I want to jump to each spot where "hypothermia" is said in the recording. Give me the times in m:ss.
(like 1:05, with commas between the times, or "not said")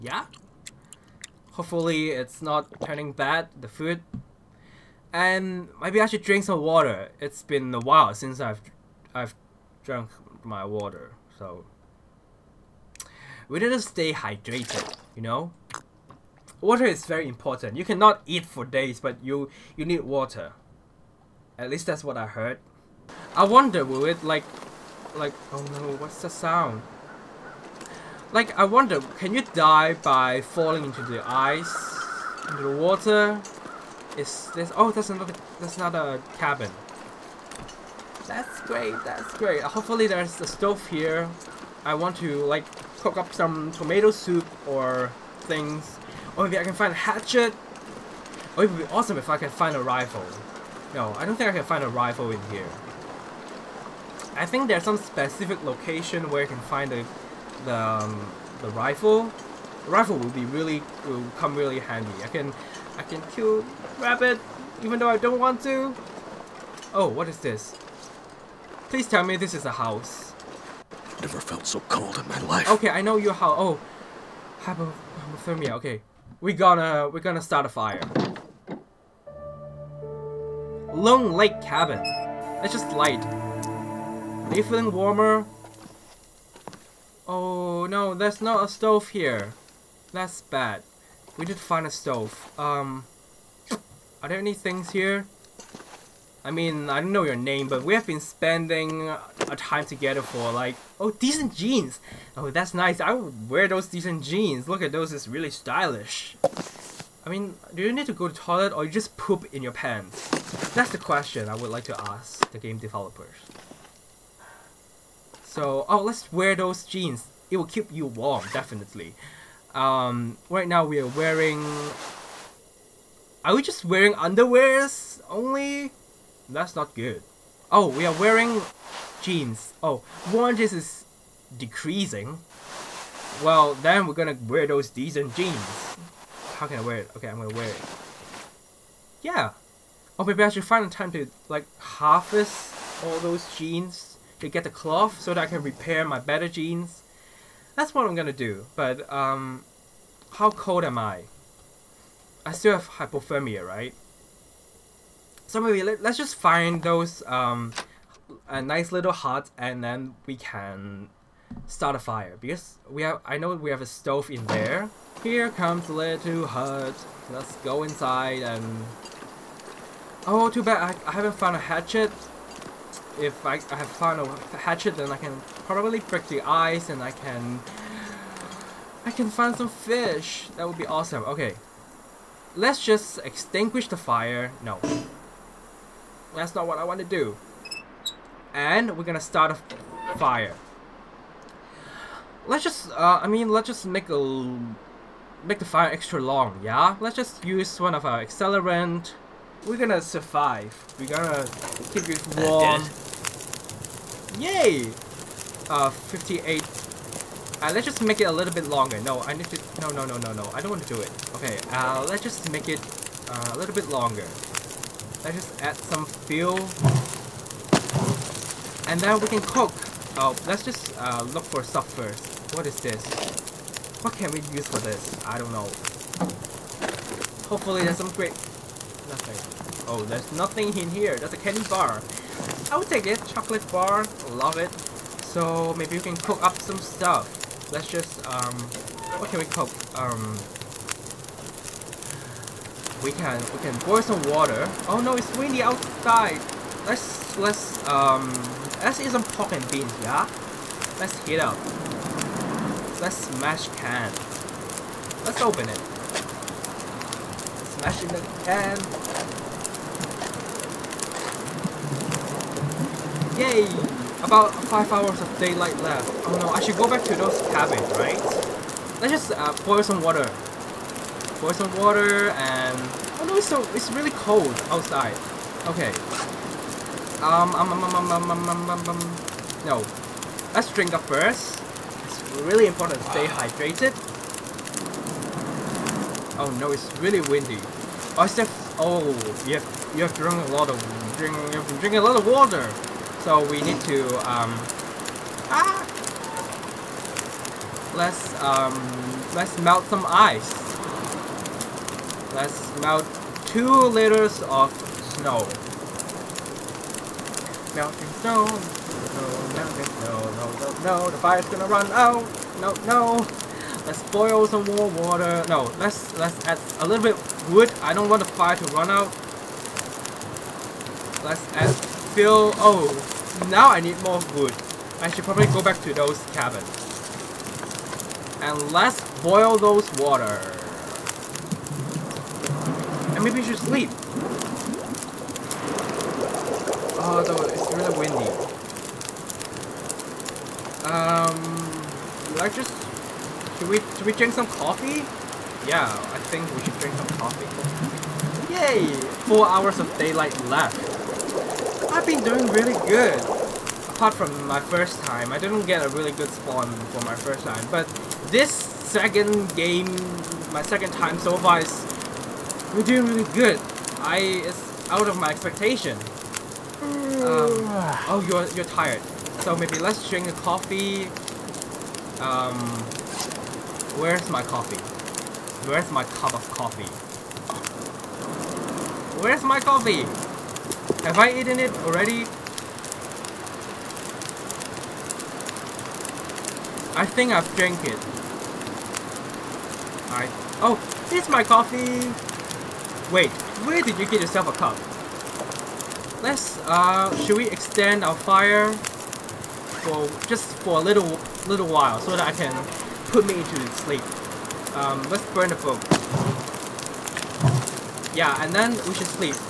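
1:14, 2:32.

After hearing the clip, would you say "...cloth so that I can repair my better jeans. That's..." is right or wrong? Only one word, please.
right.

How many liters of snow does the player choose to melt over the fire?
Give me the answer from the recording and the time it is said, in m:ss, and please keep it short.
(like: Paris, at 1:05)
2, at 5:03.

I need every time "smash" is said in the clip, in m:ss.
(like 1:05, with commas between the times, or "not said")
4:13, 4:17.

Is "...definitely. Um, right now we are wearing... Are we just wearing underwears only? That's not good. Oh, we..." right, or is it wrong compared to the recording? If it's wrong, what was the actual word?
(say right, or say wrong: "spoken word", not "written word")
right.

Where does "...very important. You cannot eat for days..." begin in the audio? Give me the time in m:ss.
0:17.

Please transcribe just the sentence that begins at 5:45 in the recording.
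Yeah, I think we should drink some coffee.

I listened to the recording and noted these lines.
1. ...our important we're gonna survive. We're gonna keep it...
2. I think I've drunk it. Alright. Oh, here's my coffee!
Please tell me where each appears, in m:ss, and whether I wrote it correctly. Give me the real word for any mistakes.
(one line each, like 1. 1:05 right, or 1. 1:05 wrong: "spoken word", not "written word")
1. 3:18 wrong: "accelerant", not "important"
2. 6:26 wrong: "drank", not "drunk".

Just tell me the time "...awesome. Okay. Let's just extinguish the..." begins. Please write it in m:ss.
3:00.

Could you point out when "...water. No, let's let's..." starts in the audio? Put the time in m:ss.
5:14.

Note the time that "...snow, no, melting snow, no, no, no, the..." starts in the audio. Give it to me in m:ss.
5:08.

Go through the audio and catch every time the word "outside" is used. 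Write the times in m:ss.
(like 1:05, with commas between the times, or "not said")
4:05, 4:34.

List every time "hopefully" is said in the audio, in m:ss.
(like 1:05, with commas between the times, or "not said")
0:01, 0:39, 3:47.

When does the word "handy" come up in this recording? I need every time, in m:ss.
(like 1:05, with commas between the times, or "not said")
1:01.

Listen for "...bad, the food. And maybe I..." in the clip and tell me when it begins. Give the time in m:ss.
0:03.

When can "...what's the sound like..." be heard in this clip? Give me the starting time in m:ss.
0:25.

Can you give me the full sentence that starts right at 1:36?
I mean, I don't know your name, but we have been spending a time together for like, oh, decent jeans.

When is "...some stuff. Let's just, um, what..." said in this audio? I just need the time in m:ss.
3:56.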